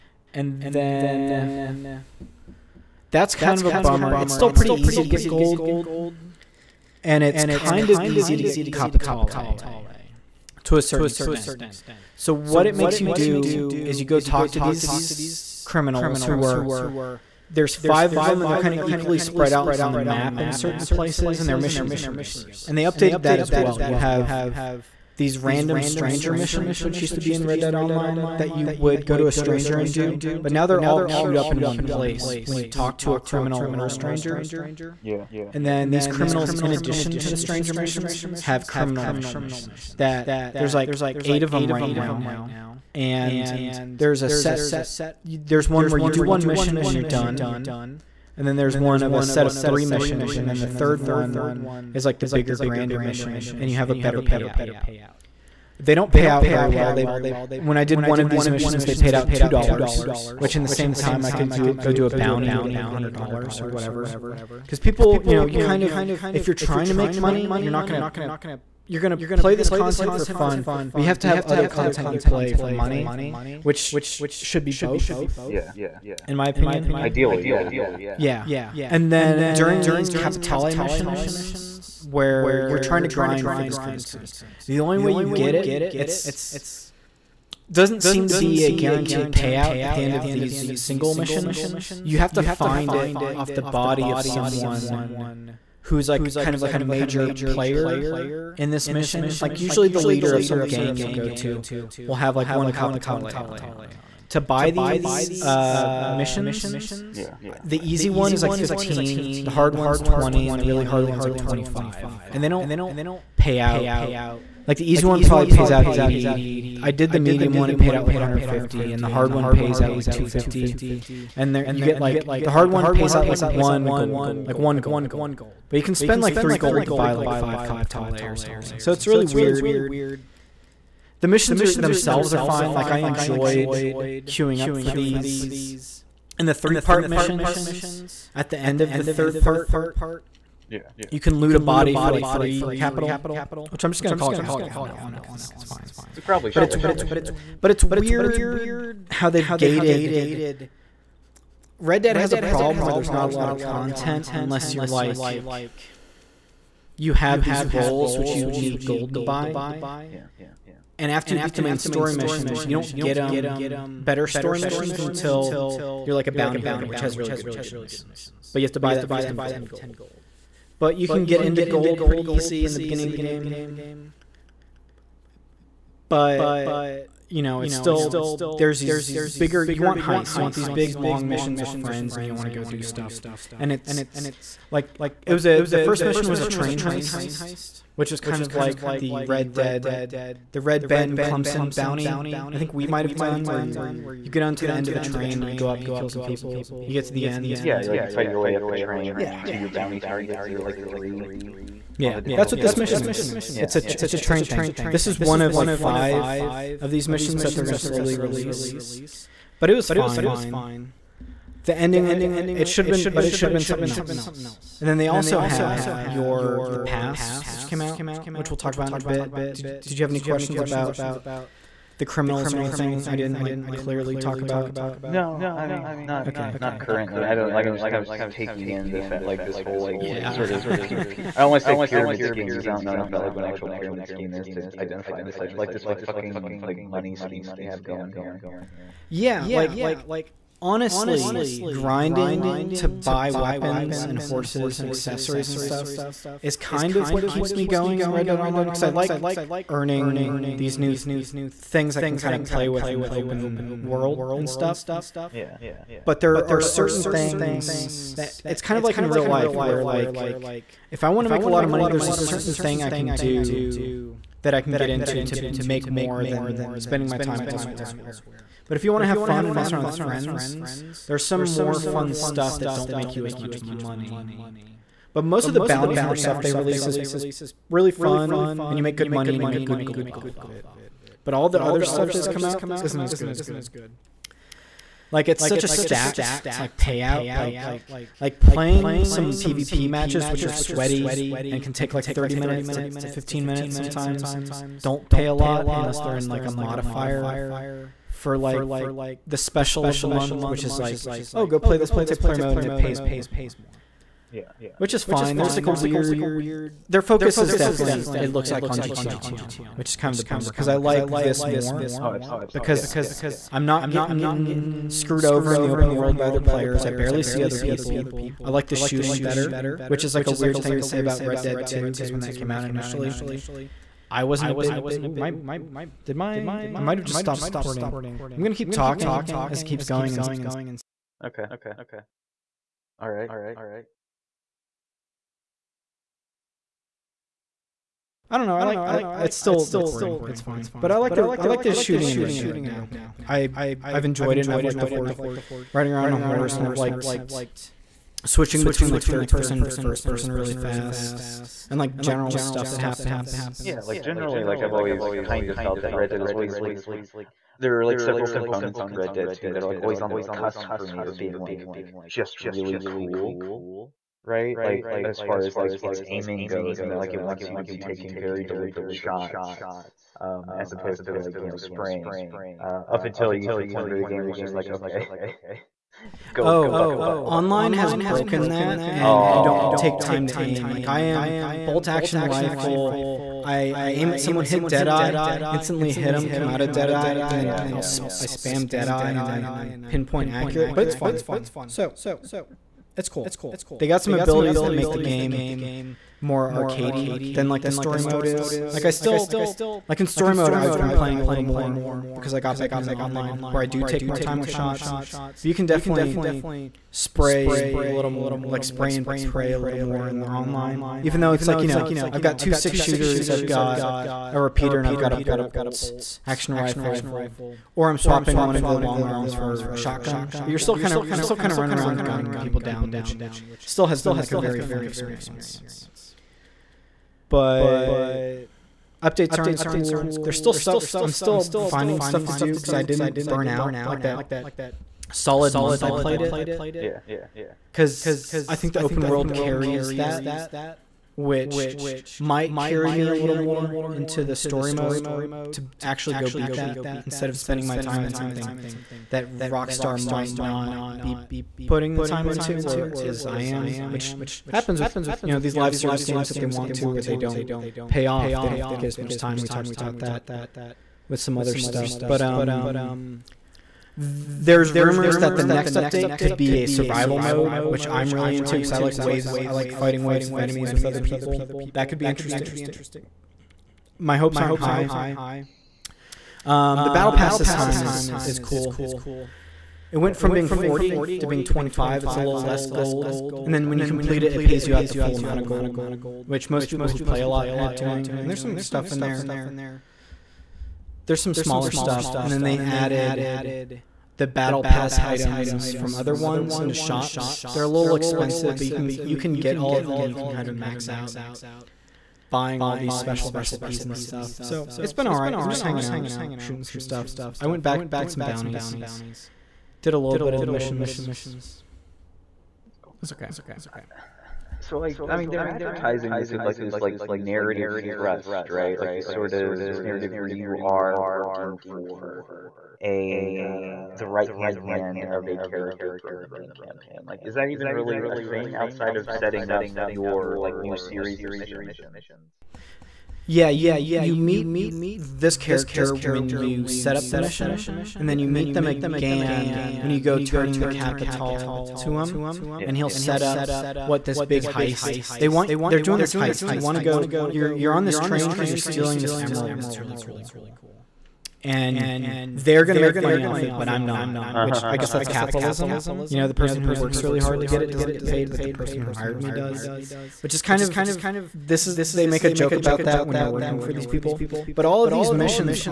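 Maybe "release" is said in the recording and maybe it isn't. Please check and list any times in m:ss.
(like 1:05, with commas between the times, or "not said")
3:28, 4:36.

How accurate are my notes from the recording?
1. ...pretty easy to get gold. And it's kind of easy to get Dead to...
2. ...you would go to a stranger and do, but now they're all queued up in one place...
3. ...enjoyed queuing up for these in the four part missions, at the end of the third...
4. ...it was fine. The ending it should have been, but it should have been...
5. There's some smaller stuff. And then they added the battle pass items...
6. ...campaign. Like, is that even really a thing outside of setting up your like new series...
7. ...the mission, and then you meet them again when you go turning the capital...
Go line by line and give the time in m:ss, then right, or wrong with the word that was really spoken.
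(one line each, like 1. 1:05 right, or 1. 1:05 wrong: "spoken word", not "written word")
1. 0:04 wrong: "Capitale", not "Dead"
2. 0:28 right
3. 2:12 wrong: "three", not "four"
4. 3:29 right
5. 8:11 right
6. 8:46 right
7. 8:57 right.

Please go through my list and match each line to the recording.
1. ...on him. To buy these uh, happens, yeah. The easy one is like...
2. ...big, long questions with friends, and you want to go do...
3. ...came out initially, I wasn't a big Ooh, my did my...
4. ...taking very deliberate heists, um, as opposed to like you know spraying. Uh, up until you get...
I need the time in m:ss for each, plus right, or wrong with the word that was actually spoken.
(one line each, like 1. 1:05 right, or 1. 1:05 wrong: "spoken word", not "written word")
1. 1:43 wrong: "missions", not "happens"
2. 3:00 wrong: "missions", not "questions"
3. 5:22 right
4. 6:07 wrong: "shots", not "heists".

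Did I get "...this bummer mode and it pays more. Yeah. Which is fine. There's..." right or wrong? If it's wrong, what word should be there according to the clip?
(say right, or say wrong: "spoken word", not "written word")
wrong: "multiplayer", not "bummer".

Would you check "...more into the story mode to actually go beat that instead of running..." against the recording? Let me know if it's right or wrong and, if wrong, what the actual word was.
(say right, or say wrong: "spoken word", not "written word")
wrong: "spending", not "running".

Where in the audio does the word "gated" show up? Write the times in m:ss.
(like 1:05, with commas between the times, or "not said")
2:29.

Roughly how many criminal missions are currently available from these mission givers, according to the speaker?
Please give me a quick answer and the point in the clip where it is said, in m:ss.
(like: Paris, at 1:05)
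8, at 0:41.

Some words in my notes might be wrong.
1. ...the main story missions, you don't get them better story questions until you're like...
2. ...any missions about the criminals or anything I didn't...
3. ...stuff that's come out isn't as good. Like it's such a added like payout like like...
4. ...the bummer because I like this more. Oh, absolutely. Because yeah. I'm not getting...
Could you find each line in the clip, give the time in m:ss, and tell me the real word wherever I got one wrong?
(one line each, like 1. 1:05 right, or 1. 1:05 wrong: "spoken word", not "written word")
1. 2:41 wrong: "missions", not "questions"
2. 3:40 wrong: "questions", not "missions"
3. 4:41 wrong: "stacked", not "added"
4. 5:10 right.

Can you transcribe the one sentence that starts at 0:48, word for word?
And then there's one of a set of three missions.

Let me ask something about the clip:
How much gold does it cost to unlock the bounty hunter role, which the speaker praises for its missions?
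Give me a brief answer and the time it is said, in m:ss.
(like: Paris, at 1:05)
10 gold, at 2:49.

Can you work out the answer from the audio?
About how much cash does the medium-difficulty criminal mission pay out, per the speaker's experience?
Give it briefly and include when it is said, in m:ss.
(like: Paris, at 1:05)
150, at 1:58.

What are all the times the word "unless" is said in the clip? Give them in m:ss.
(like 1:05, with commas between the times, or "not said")
2:34, 4:55.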